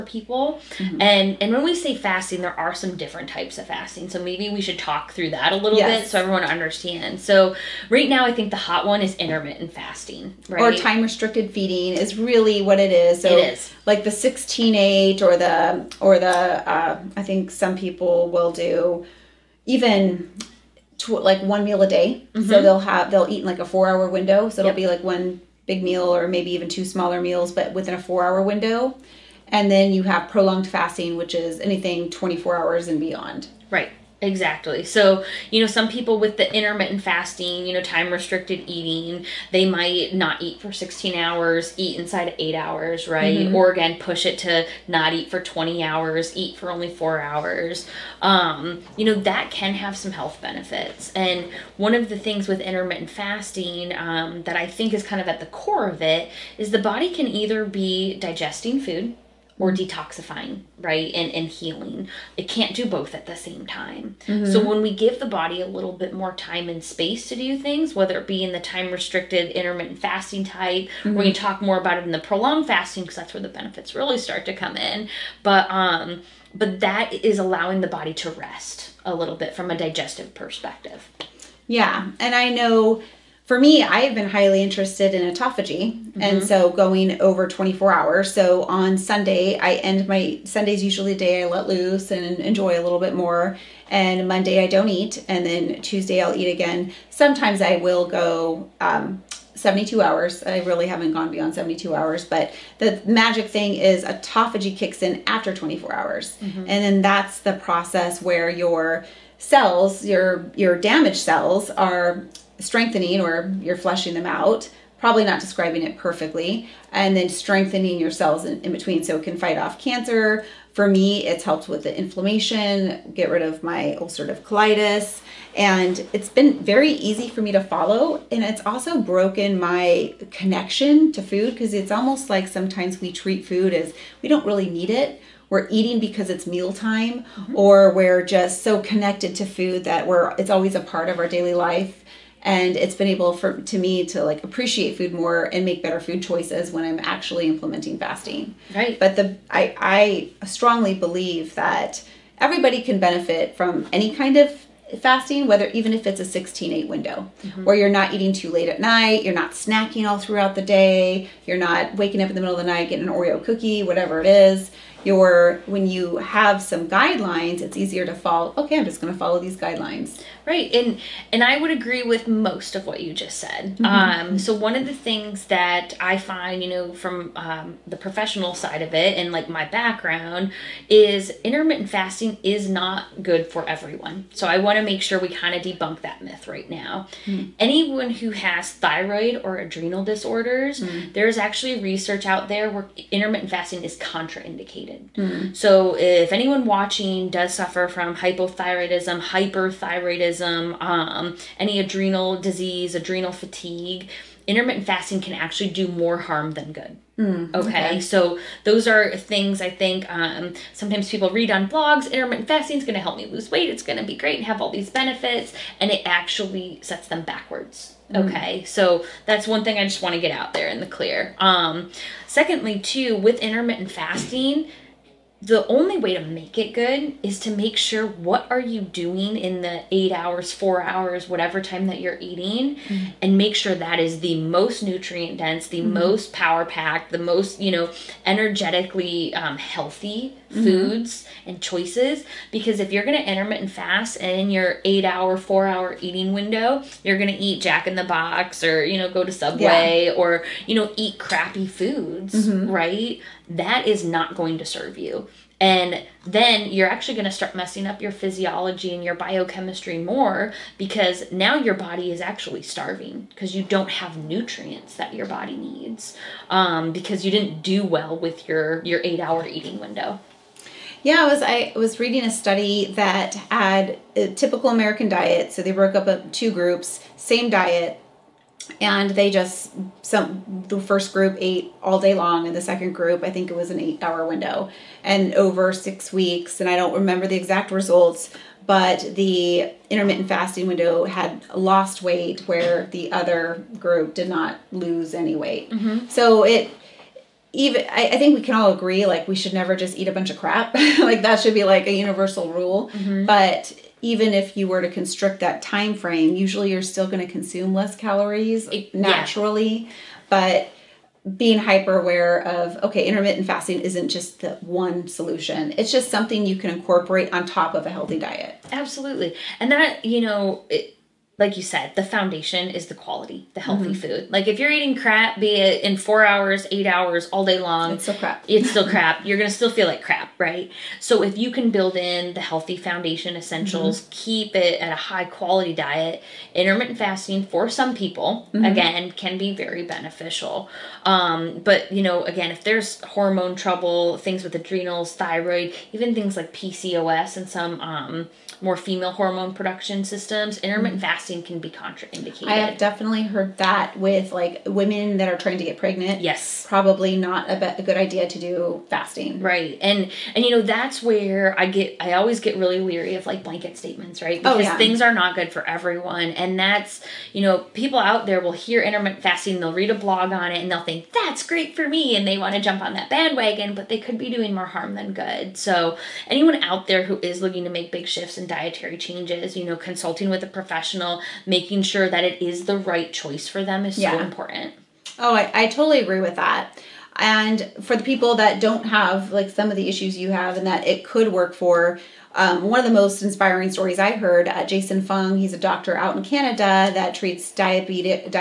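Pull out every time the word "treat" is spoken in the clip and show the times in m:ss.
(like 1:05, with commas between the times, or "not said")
2:13, 6:37.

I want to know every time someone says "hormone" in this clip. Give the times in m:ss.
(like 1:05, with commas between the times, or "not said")
5:43, 5:49.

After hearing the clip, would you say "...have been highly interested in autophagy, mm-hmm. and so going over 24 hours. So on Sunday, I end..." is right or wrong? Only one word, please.
right.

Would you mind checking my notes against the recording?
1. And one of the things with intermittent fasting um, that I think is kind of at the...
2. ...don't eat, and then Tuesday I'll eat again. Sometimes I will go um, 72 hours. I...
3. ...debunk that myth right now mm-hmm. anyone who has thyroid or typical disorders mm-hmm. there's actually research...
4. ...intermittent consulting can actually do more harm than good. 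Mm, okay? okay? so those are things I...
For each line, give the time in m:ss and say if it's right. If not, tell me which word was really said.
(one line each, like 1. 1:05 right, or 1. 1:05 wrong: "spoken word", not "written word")
1. 0:51 right
2. 1:34 right
3. 3:05 wrong: "adrenal", not "typical"
4. 3:24 wrong: "fasting", not "consulting".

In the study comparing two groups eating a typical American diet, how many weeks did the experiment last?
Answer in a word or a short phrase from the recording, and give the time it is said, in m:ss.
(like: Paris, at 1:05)
6, at 4:45.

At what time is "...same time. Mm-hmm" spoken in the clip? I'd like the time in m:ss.
1:03.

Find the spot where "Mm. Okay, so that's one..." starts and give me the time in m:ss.
3:38.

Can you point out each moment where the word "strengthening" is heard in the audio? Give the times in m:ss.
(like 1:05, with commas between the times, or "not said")
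1:52, 1:57.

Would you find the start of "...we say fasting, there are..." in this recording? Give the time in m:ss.
0:01.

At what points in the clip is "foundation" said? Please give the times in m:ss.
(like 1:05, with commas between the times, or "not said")
5:22, 5:32.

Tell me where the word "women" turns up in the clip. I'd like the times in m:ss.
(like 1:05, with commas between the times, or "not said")
5:54.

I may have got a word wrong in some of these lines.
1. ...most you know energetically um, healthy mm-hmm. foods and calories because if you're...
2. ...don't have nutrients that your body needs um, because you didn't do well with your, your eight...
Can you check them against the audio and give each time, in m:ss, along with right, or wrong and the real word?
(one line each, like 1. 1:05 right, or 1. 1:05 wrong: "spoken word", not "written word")
1. 3:57 wrong: "choices", not "calories"
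2. 4:23 right.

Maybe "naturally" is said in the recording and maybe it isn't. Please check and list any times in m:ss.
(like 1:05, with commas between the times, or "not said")
5:08.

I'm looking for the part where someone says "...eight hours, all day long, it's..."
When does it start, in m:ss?
5:26.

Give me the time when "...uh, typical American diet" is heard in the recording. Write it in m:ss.
4:34.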